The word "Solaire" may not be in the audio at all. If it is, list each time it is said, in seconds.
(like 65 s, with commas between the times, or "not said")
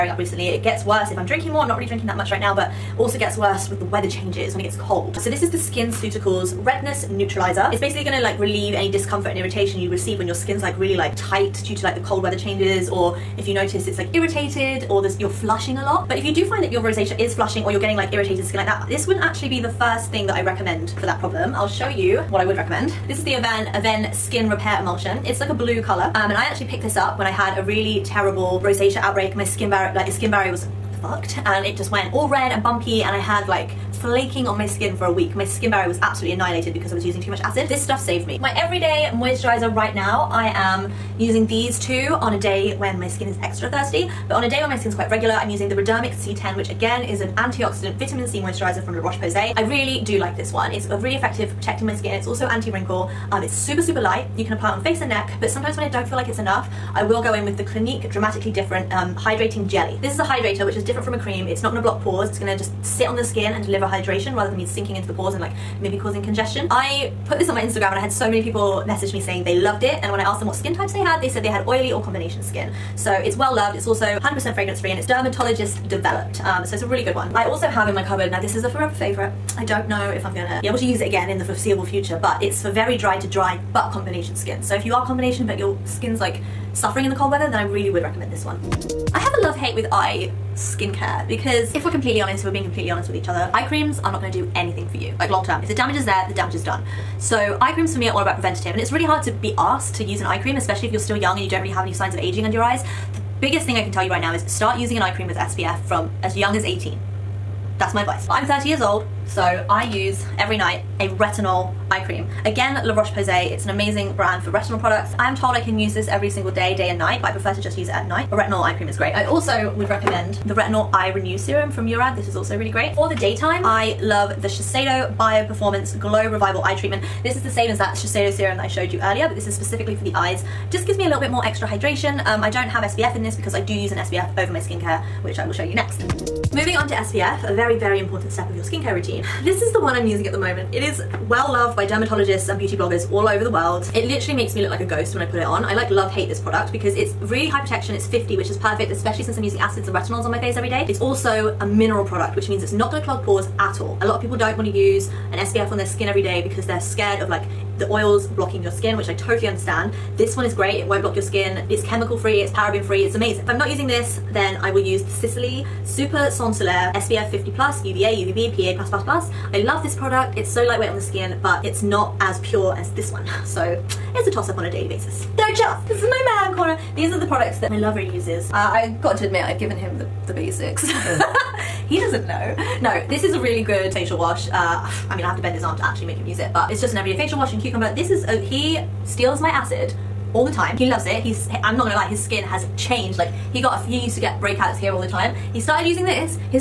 166 s.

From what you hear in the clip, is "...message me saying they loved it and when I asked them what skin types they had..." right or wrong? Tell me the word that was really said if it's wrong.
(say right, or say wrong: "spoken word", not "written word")
right.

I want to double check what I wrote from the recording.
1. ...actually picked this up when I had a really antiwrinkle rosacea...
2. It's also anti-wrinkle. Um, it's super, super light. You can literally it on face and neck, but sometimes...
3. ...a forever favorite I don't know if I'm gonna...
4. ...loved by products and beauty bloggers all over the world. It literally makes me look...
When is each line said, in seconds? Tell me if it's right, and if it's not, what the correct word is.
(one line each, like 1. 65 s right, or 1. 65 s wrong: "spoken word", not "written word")
1. 26 s wrong: "terrible", not "antiwrinkle"
2. 52 s wrong: "apply", not "literally"
3. 78 s right
4. 141 s wrong: "dermatologists", not "products".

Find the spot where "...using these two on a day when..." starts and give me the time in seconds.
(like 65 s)
41 s.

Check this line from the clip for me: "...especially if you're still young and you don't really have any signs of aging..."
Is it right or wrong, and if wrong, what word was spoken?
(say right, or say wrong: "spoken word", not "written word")
right.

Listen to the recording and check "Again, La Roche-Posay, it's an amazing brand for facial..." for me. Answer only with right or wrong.
wrong.